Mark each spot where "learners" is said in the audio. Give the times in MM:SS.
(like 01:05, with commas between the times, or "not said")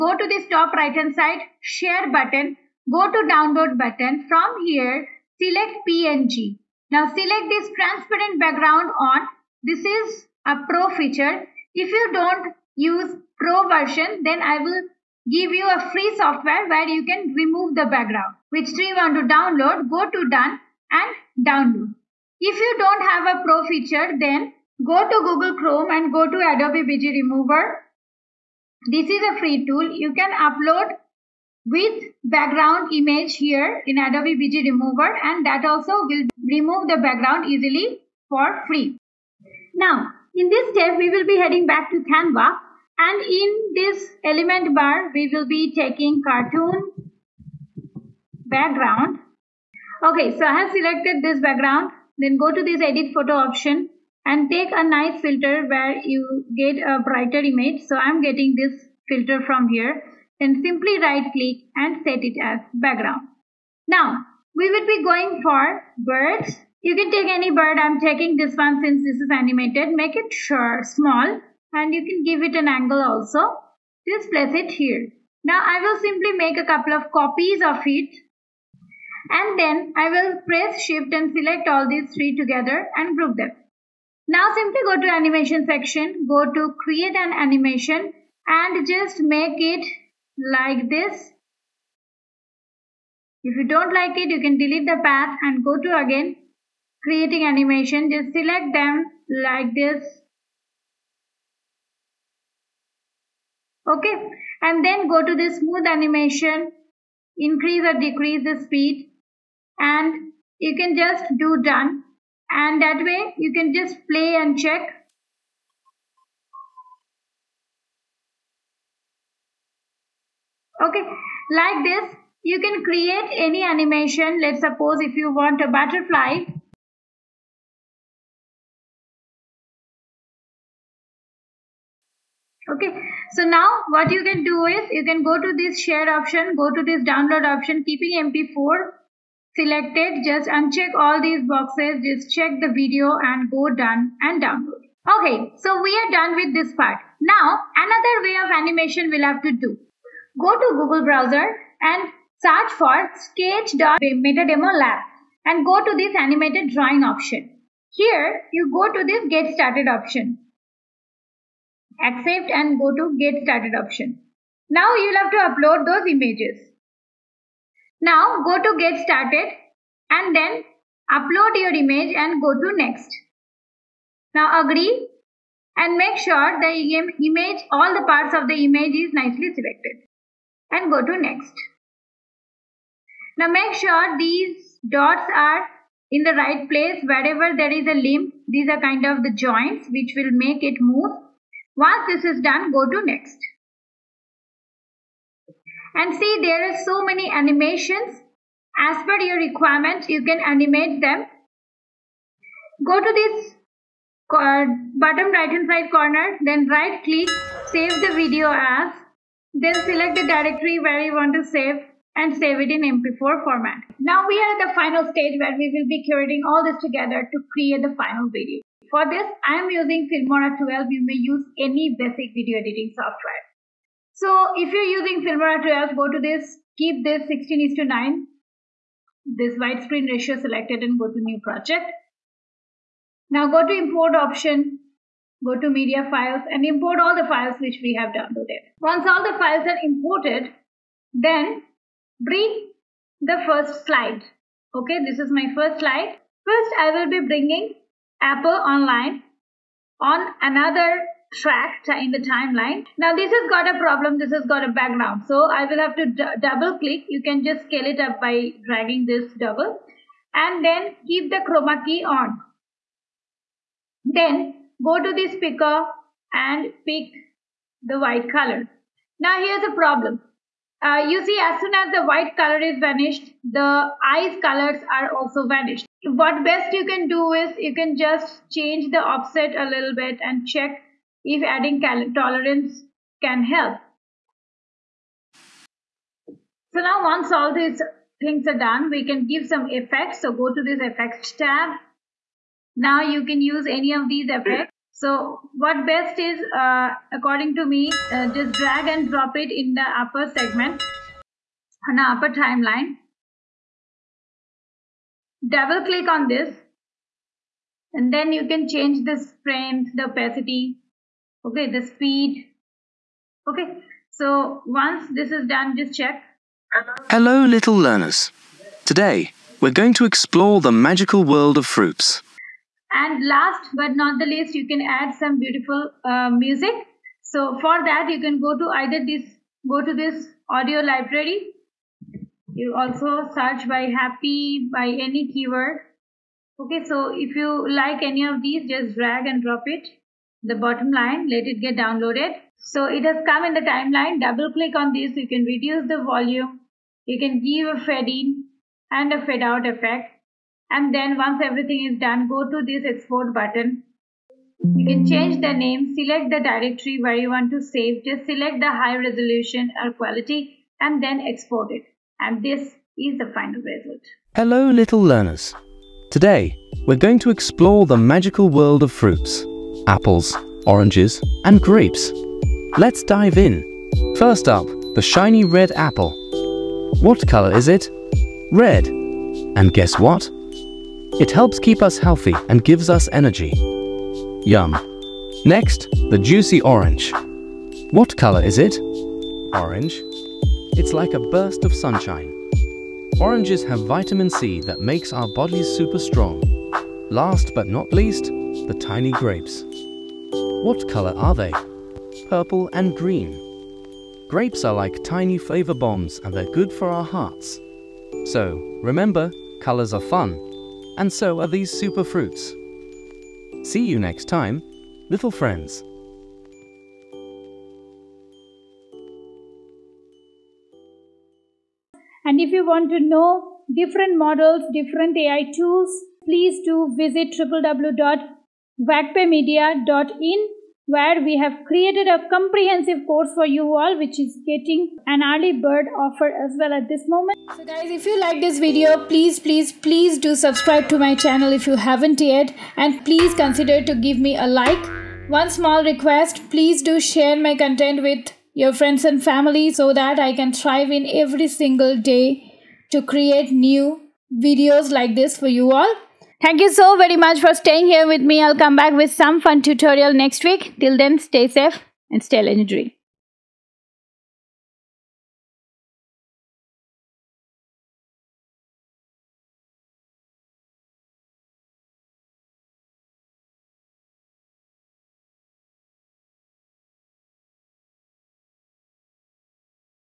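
05:17, 06:05.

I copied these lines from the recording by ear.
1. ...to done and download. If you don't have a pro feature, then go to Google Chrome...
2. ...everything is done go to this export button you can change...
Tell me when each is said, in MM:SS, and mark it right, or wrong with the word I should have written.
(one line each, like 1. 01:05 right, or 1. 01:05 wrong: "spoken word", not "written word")
1. 00:20 right
2. 05:51 right.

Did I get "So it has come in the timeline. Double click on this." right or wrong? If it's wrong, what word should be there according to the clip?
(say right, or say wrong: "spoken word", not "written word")
right.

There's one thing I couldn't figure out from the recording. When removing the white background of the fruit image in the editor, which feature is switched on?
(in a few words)
Chroma key.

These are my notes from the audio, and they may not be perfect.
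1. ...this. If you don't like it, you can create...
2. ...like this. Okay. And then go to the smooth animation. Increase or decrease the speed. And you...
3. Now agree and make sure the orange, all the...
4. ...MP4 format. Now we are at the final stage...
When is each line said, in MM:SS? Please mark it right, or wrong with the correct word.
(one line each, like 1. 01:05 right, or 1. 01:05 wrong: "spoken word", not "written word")
1. 01:30 wrong: "delete", not "create"
2. 01:39 right
3. 02:54 wrong: "image", not "orange"
4. 03:32 right.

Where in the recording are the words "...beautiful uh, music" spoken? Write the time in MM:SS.
05:25.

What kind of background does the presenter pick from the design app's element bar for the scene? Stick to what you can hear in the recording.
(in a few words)
Cartoon background.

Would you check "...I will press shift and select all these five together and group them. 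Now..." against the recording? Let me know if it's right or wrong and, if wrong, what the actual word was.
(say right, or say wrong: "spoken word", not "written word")
wrong: "three", not "five".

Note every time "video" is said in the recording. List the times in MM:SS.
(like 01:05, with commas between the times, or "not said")
02:22, 03:28, 03:38, 03:42, 07:18, 07:34.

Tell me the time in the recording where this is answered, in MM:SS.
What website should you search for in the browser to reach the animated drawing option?
02:33.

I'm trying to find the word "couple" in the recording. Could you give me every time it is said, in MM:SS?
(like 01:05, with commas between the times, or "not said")
01:16.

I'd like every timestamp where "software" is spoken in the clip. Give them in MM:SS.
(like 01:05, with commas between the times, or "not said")
00:16, 03:42.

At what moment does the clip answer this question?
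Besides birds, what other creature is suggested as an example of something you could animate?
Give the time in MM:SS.
02:05.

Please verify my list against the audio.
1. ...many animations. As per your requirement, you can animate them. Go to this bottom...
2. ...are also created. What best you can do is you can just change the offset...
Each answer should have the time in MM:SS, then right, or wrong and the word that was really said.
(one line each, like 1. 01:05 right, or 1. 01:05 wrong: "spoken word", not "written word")
1. 03:17 right
2. 04:34 wrong: "vanished", not "created".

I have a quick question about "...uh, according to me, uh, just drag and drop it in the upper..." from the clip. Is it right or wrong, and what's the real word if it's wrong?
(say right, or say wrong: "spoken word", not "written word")
right.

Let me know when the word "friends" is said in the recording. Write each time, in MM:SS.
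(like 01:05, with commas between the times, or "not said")
06:55, 07:28.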